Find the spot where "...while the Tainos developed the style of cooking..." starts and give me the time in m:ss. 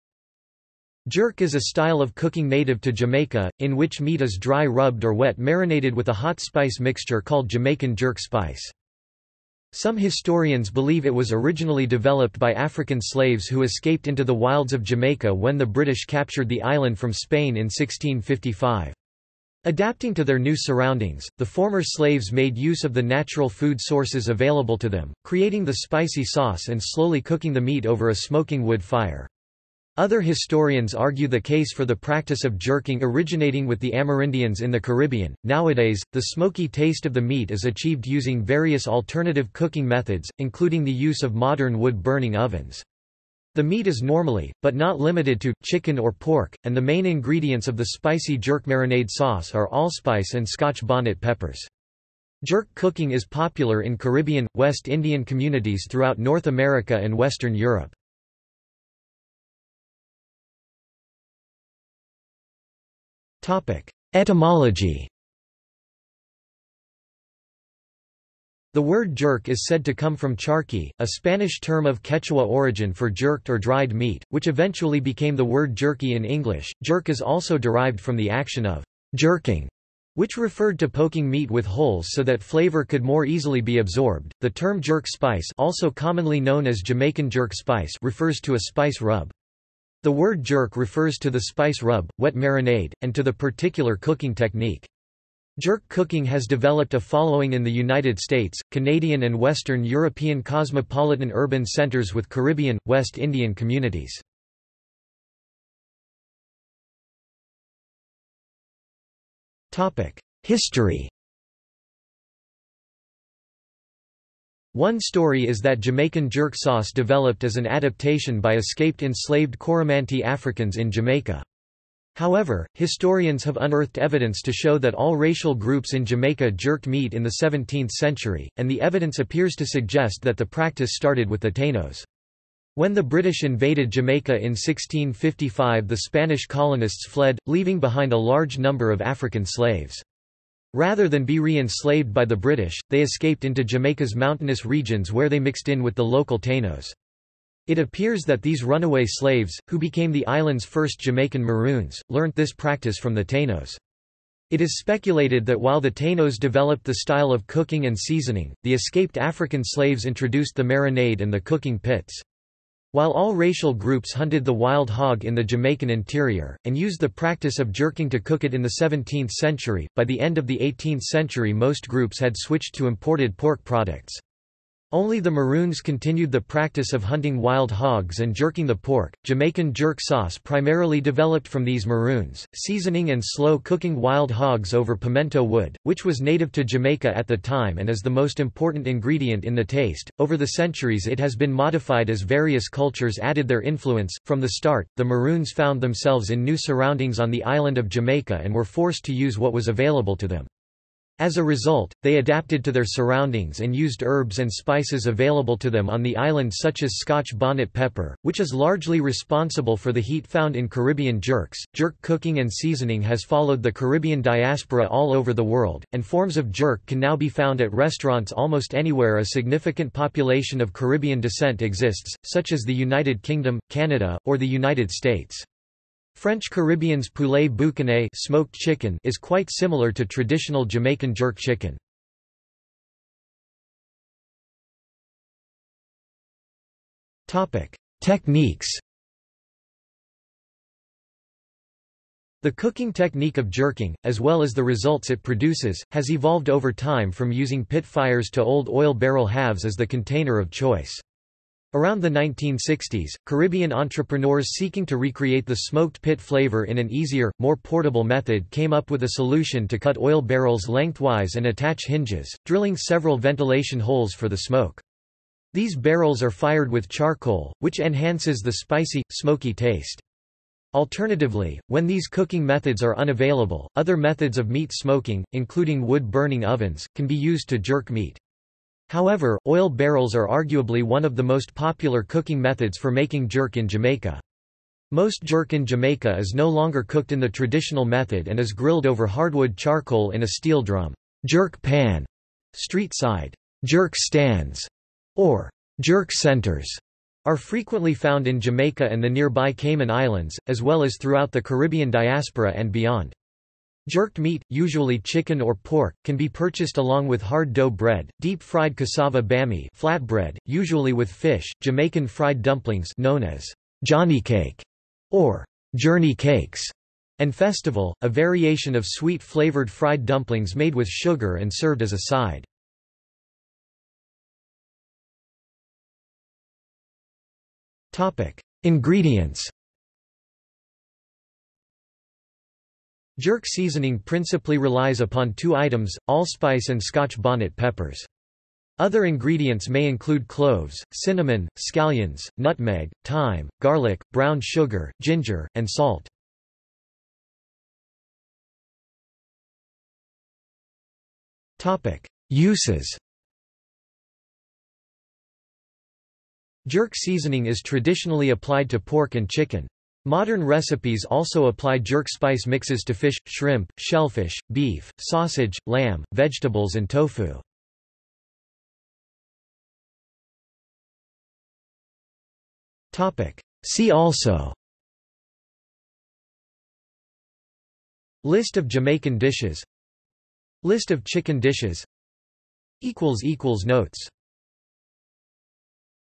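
2:35.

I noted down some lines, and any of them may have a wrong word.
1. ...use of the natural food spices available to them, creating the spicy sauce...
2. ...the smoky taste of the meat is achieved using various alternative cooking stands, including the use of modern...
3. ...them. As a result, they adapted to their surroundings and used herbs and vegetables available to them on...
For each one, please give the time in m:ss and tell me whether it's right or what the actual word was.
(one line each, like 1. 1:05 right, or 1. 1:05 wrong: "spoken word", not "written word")
1. 0:22 wrong: "sources", not "spices"
2. 0:36 wrong: "methods", not "stands"
3. 3:20 wrong: "spices", not "vegetables".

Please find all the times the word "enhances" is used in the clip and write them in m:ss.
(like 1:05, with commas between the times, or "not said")
4:27.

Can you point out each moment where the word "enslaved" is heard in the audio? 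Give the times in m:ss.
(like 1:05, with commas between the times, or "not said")
1:59, 2:21.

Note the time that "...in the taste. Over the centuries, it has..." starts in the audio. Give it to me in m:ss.
3:09.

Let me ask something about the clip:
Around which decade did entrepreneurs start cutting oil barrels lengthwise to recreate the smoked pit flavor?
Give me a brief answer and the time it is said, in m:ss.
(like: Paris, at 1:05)
1960s, at 4:12.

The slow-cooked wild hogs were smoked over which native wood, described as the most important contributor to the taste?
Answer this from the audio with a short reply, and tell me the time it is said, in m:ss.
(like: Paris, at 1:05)
pimento wood, at 3:04.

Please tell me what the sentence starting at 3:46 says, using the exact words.
French Caribbean's poulet boucané smoked chicken is quite similar to traditional Jamaican jerk chicken.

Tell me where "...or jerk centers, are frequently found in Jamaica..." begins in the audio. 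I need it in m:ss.
4:55.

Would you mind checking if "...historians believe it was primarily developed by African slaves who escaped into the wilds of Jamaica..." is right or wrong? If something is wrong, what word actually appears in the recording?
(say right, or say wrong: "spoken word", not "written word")
wrong: "originally", not "primarily".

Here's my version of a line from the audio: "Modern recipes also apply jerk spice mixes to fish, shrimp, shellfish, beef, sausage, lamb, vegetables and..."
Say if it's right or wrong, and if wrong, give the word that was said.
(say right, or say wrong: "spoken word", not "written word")
right.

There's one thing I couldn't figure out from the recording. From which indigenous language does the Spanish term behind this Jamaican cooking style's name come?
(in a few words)
Quechua.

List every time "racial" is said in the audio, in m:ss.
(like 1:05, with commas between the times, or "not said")
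2:05, 2:43.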